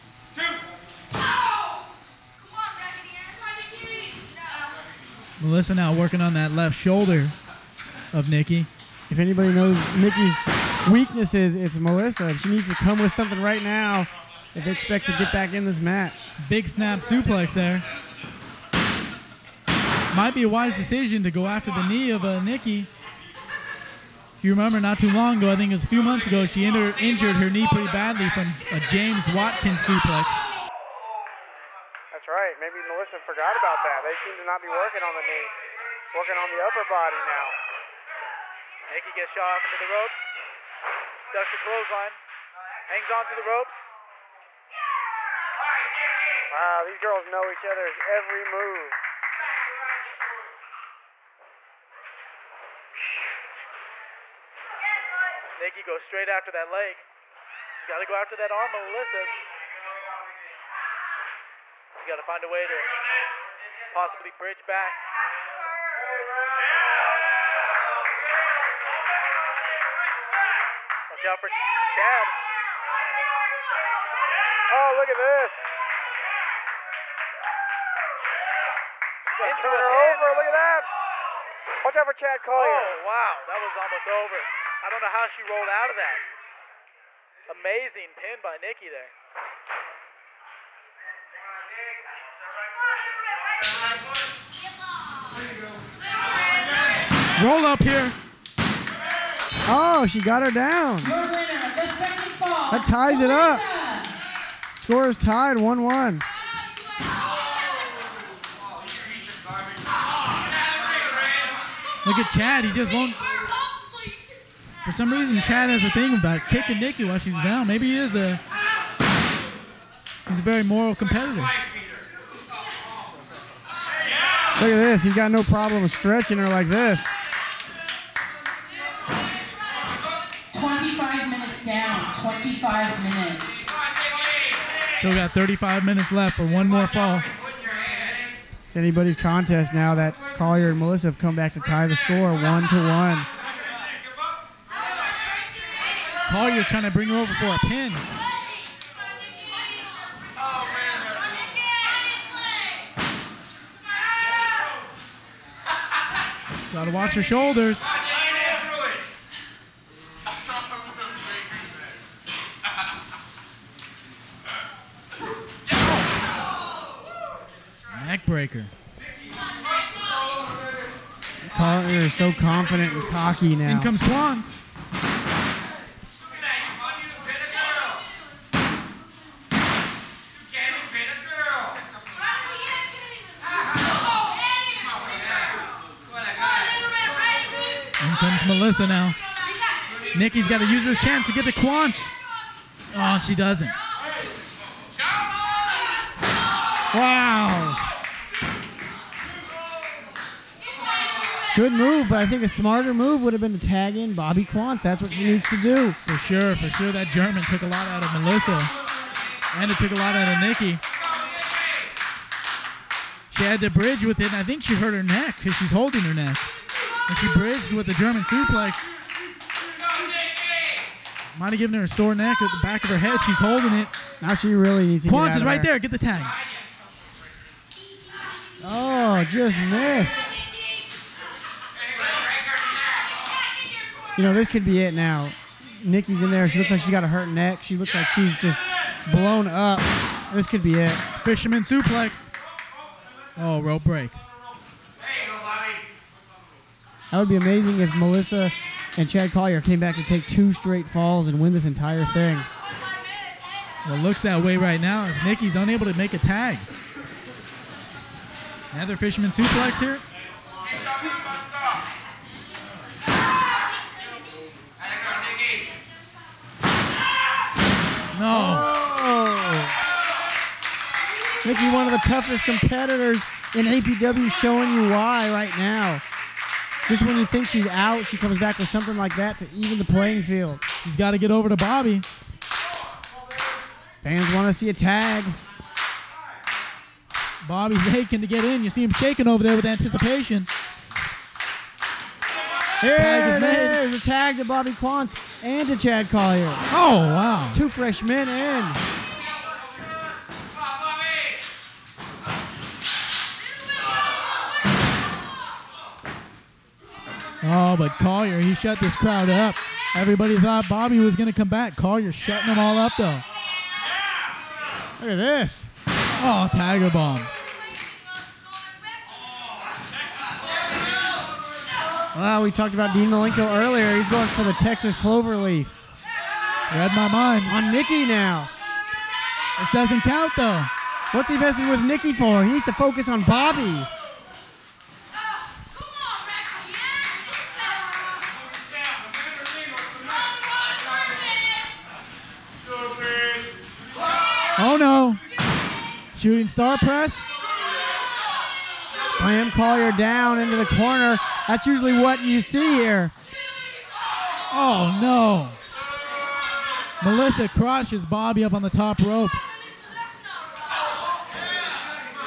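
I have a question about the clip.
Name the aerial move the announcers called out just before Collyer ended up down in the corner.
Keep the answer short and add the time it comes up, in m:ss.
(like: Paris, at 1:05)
Shooting star press, at 5:46.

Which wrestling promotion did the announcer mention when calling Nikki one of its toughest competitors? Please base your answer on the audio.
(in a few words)
APW.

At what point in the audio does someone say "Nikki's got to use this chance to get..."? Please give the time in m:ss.
3:10.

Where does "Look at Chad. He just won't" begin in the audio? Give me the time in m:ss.
1:52.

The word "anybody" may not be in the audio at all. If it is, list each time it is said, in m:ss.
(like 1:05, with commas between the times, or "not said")
0:09, 2:18.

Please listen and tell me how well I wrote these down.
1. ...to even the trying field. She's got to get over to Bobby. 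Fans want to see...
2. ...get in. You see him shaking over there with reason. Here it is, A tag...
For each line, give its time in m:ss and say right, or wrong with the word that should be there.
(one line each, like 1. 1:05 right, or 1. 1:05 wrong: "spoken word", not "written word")
1. 4:39 wrong: "playing", not "trying"
2. 4:48 wrong: "anticipation", not "reason".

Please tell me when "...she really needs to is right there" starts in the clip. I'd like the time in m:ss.
3:44.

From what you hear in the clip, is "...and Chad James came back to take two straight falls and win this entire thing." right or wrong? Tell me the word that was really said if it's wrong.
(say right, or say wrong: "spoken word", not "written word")
wrong: "Collyer", not "James".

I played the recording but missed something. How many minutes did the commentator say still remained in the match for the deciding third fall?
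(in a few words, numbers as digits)
35.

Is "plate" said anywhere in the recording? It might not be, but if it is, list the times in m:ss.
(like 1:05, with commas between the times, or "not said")
not said.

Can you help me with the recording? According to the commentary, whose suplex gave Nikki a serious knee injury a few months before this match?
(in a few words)
James Watkins.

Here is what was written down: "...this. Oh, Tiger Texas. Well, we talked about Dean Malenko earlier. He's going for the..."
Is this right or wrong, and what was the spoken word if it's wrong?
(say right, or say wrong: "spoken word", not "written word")
wrong: "Bomb", not "Texas".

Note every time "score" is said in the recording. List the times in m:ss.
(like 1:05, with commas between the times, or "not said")
1:44, 2:21.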